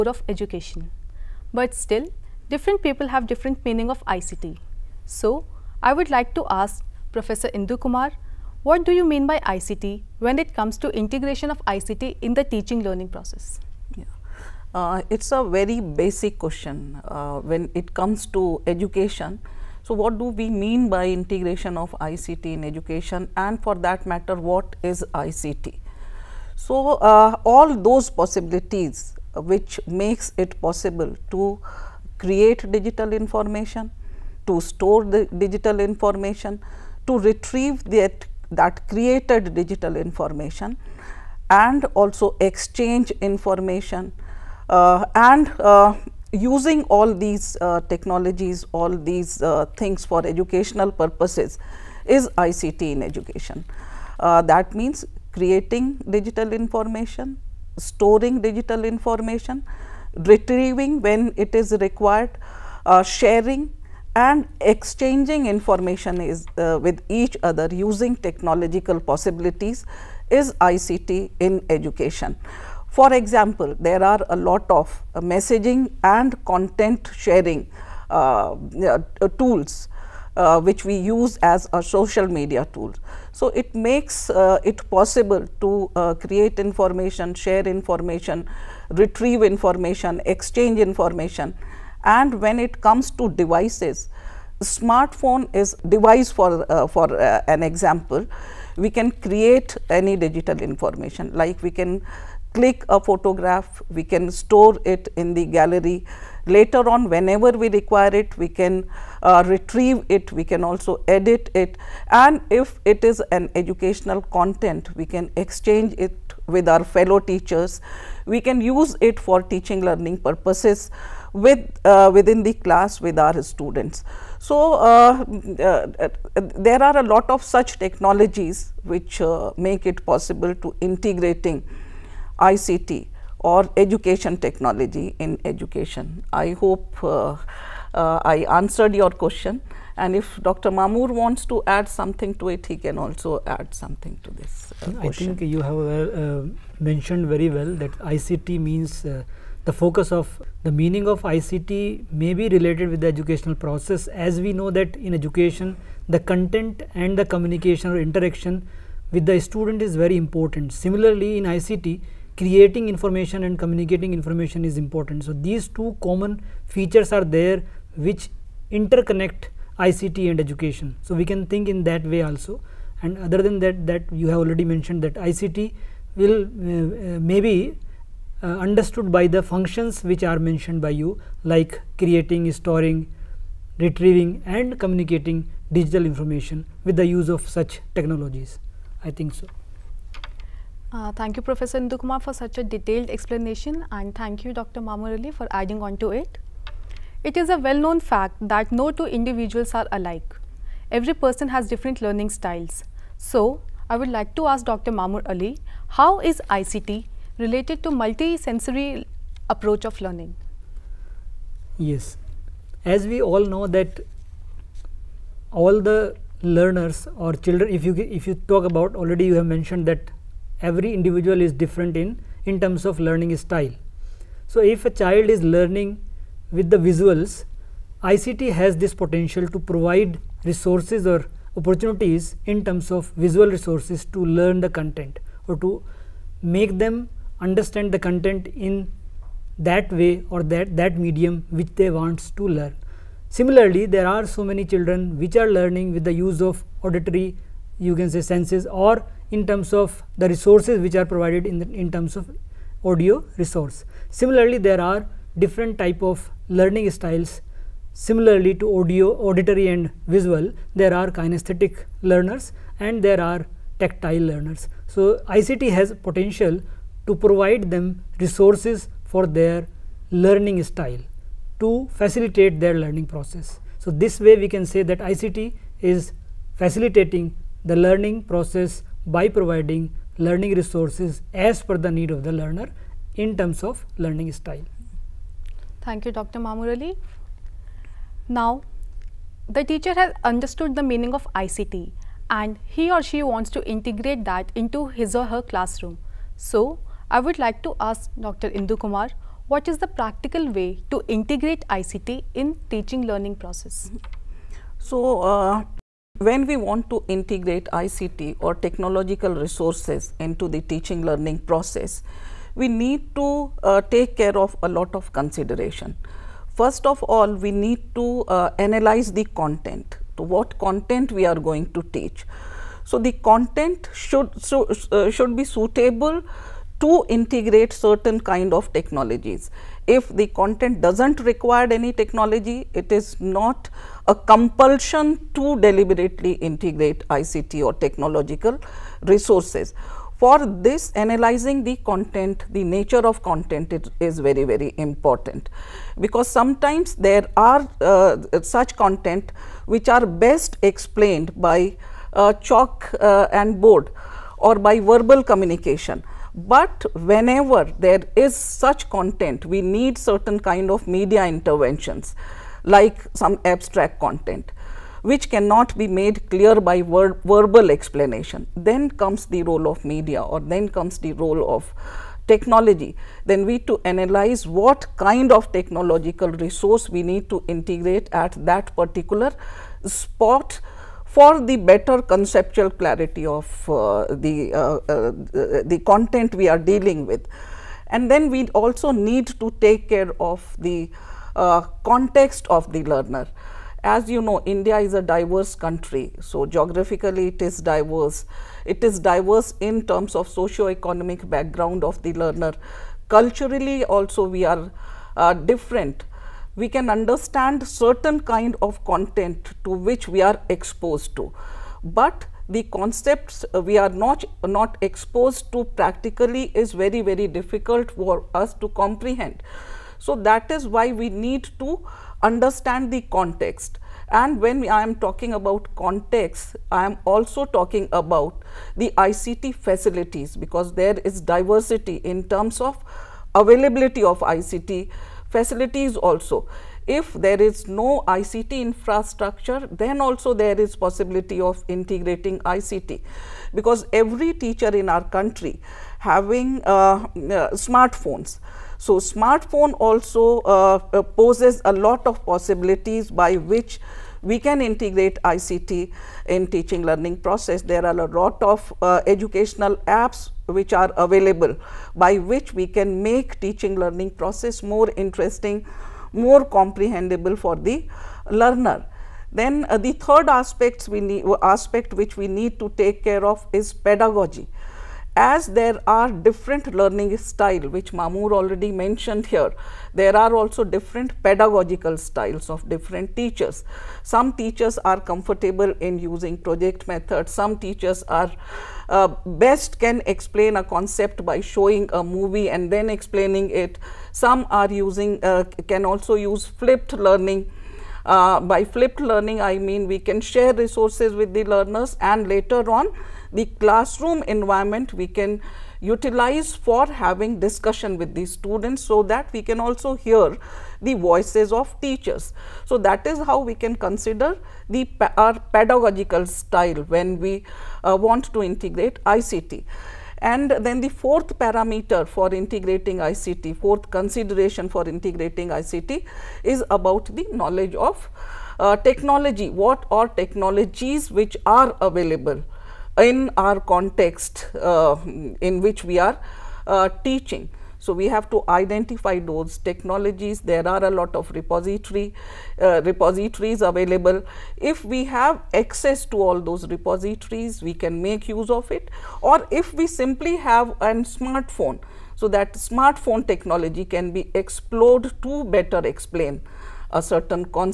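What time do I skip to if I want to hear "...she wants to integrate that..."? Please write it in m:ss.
4:53.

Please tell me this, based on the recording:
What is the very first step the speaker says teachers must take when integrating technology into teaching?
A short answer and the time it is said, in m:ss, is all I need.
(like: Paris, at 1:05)
Analyze the content, at 5:18.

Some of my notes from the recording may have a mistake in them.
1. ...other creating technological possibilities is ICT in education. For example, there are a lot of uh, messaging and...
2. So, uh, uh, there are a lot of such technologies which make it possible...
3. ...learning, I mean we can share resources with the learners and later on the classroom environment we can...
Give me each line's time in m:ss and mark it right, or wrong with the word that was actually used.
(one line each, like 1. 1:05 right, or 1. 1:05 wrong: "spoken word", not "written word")
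1. 1:07 wrong: "using", not "creating"
2. 2:04 right
3. 8:18 right.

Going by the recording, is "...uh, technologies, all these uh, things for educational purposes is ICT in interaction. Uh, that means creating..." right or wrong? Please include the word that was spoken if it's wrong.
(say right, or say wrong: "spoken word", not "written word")
wrong: "education", not "interaction".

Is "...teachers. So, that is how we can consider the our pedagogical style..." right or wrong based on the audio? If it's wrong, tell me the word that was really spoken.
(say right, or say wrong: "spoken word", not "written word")
right.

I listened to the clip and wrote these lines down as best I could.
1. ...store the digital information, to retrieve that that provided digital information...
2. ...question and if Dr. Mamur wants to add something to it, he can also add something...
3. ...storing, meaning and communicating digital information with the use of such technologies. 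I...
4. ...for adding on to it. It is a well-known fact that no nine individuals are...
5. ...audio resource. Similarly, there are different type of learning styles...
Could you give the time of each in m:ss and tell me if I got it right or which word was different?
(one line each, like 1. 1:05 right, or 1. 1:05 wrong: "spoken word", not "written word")
1. 0:34 wrong: "created", not "provided"
2. 2:19 right
3. 3:02 wrong: "retrieving", not "meaning"
4. 3:15 wrong: "two", not "nine"
5. 4:12 right.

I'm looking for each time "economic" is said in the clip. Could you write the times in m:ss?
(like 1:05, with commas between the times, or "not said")
6:40.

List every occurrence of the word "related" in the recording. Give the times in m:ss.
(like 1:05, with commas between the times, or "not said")
2:32, 3:27.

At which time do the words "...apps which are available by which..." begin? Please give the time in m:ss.
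7:39.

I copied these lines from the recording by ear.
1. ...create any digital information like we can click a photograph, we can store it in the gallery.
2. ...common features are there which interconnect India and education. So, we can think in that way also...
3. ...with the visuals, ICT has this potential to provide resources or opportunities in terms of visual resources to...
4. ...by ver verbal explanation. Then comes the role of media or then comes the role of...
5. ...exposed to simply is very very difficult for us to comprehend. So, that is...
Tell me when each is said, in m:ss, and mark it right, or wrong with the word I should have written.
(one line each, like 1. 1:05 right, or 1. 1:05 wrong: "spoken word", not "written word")
1. 1:39 right
2. 2:46 wrong: "ICT", not "India"
3. 3:46 right
4. 6:06 right
5. 6:54 wrong: "practically", not "simply".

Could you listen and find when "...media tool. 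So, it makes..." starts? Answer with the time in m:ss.
1:22.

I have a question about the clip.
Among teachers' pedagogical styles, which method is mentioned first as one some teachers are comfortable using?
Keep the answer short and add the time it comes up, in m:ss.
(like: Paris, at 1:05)
Project method, at 8:06.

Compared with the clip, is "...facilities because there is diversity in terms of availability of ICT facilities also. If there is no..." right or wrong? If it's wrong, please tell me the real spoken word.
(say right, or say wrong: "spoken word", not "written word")
right.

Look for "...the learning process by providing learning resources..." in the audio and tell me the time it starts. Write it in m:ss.
4:37.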